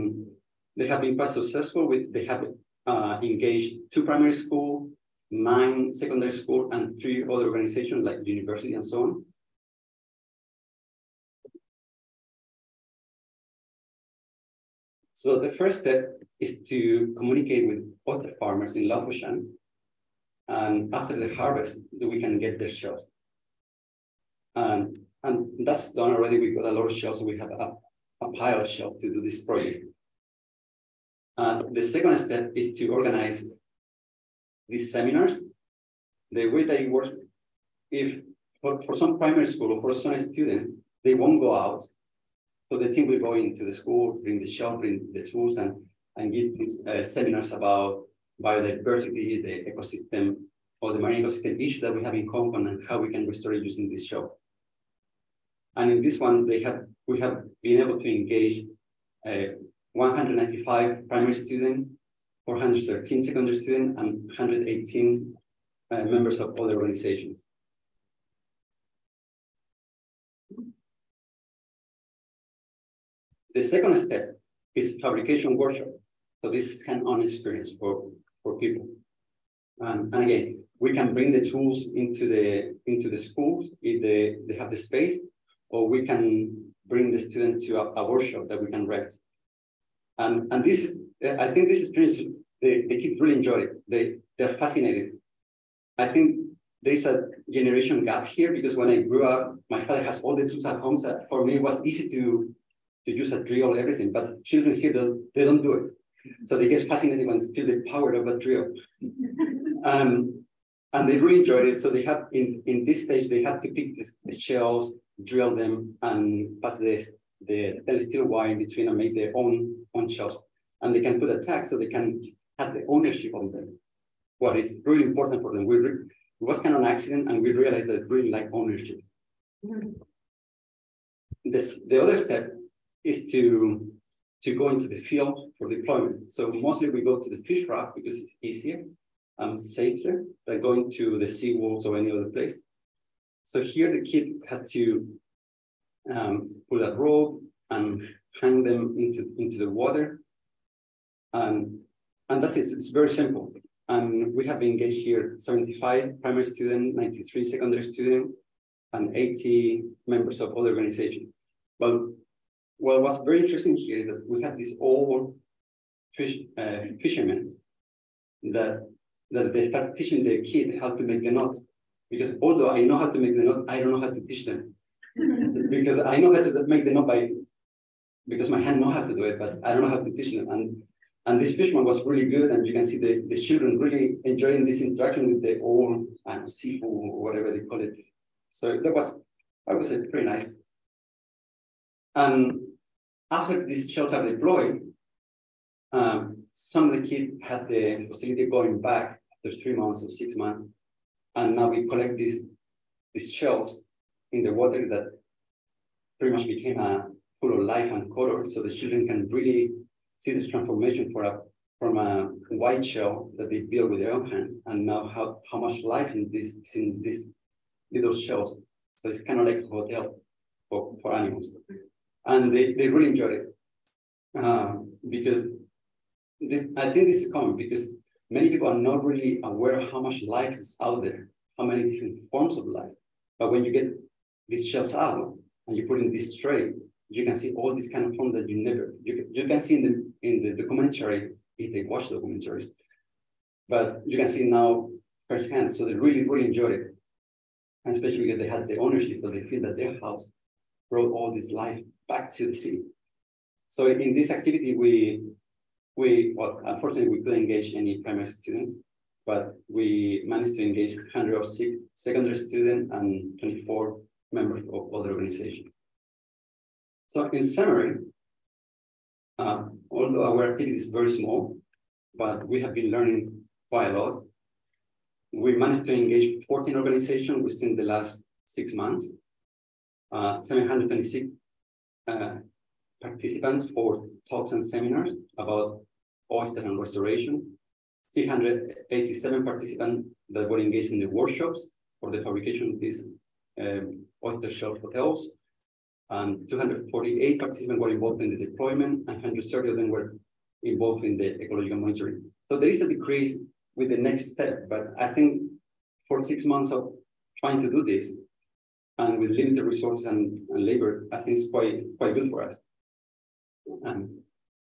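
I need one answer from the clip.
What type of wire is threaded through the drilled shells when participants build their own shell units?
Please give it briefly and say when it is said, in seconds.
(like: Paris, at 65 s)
stainless steel, at 117 s.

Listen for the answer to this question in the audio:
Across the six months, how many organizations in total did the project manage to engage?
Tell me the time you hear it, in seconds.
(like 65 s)
276 s.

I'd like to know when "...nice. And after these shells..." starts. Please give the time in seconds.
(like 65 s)
190 s.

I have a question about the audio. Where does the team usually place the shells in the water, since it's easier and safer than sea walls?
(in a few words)
fish rock.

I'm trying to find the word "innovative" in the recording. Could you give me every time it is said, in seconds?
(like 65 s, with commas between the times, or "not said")
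not said.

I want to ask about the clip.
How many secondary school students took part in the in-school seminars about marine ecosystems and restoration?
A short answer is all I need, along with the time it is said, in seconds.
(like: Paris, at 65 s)
413, at 62 s.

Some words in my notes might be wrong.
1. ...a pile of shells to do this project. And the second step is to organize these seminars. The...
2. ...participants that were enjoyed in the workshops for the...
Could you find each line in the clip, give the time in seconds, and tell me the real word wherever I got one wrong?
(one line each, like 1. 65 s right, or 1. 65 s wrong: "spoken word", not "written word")
1. 28 s right
2. 289 s wrong: "engaged", not "enjoyed".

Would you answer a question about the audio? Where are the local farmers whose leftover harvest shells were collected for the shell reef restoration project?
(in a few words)
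Lau Fau Shan.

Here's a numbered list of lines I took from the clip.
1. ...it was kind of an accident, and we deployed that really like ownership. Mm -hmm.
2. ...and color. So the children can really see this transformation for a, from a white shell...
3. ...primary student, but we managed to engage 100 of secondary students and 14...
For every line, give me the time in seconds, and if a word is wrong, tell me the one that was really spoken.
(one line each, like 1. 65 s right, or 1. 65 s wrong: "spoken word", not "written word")
1. 125 s wrong: "realized", not "deployed"
2. 207 s right
3. 258 s wrong: "24", not "14".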